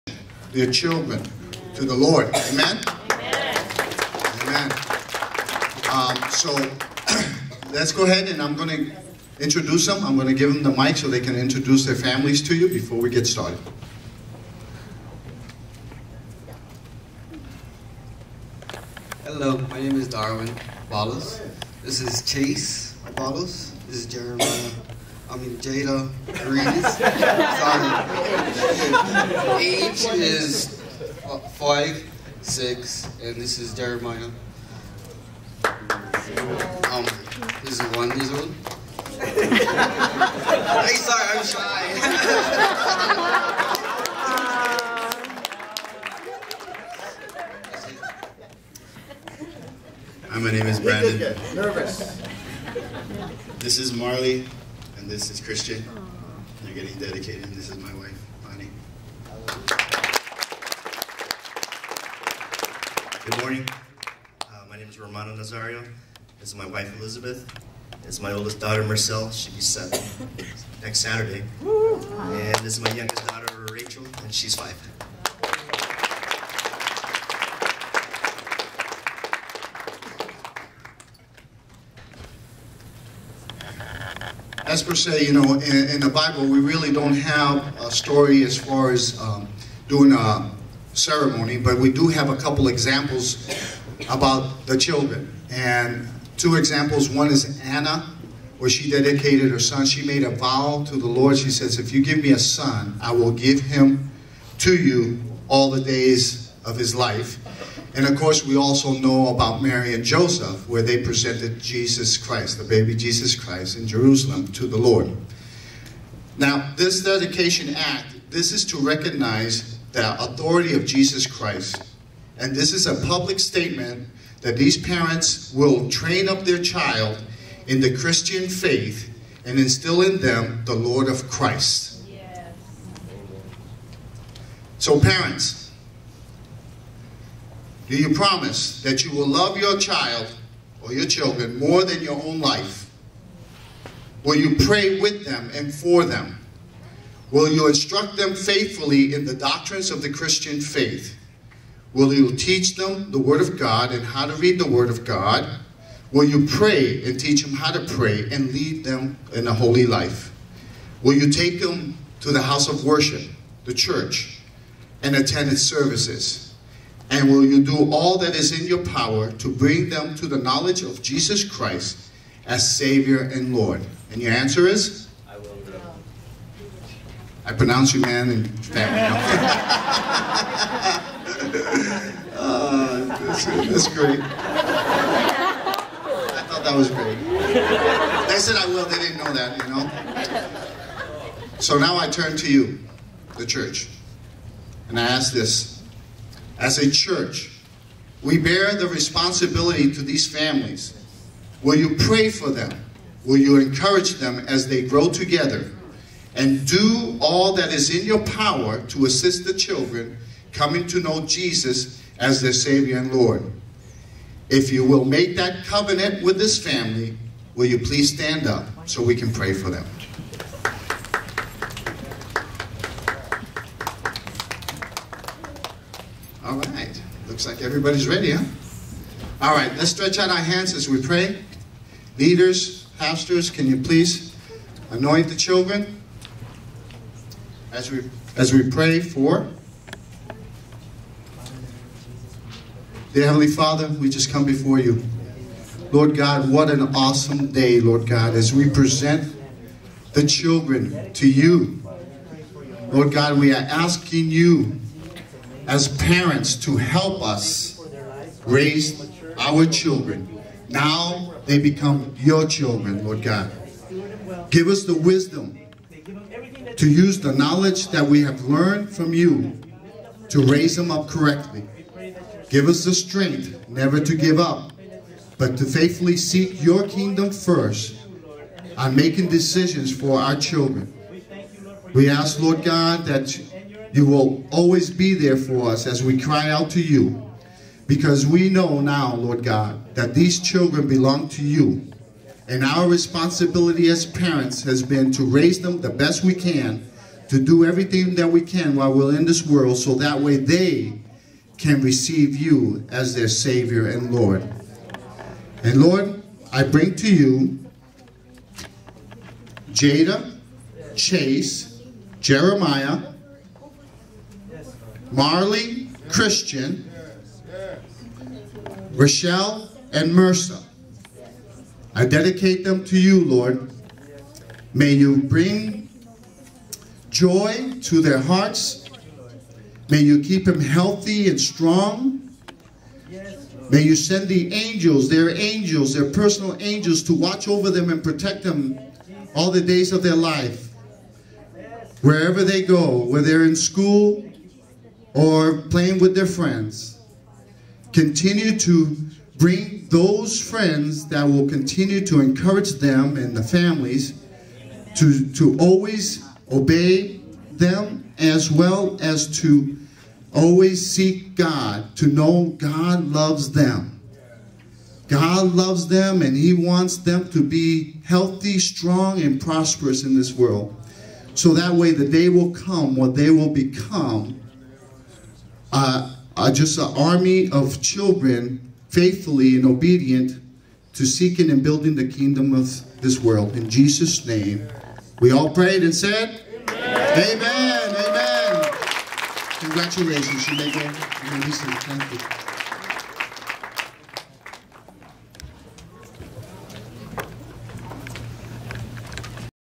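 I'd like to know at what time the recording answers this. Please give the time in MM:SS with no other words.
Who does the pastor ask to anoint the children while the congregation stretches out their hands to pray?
03:52.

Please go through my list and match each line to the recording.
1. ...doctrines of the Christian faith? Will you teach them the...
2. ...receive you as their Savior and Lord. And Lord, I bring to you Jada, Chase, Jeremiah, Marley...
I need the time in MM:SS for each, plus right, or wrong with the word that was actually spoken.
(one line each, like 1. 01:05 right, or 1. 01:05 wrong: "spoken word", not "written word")
1. 02:29 right
2. 05:01 right.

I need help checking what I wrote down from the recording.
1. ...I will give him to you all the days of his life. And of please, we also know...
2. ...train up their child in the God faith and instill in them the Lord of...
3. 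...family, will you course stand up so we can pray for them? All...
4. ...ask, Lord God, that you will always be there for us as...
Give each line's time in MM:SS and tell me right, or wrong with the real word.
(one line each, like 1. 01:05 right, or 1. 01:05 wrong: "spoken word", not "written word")
1. 01:43 wrong: "course", not "please"
2. 02:05 wrong: "Christian", not "God"
3. 03:36 wrong: "please", not "course"
4. 04:42 right.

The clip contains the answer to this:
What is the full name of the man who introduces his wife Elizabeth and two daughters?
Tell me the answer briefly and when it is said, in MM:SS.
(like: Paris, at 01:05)
Romano Nazario, at 01:04.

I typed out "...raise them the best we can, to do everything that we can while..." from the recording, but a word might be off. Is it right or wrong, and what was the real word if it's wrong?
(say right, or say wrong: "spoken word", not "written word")
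right.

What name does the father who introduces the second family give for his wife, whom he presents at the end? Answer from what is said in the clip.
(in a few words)
Bonnie.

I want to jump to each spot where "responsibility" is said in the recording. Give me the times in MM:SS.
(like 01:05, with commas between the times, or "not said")
03:18, 04:52.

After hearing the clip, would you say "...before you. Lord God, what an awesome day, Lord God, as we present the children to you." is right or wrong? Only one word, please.
right.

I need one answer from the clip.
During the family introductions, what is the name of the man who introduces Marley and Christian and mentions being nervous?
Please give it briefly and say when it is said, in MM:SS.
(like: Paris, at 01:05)
Brandon, at 00:50.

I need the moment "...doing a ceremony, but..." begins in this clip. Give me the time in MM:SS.
01:29.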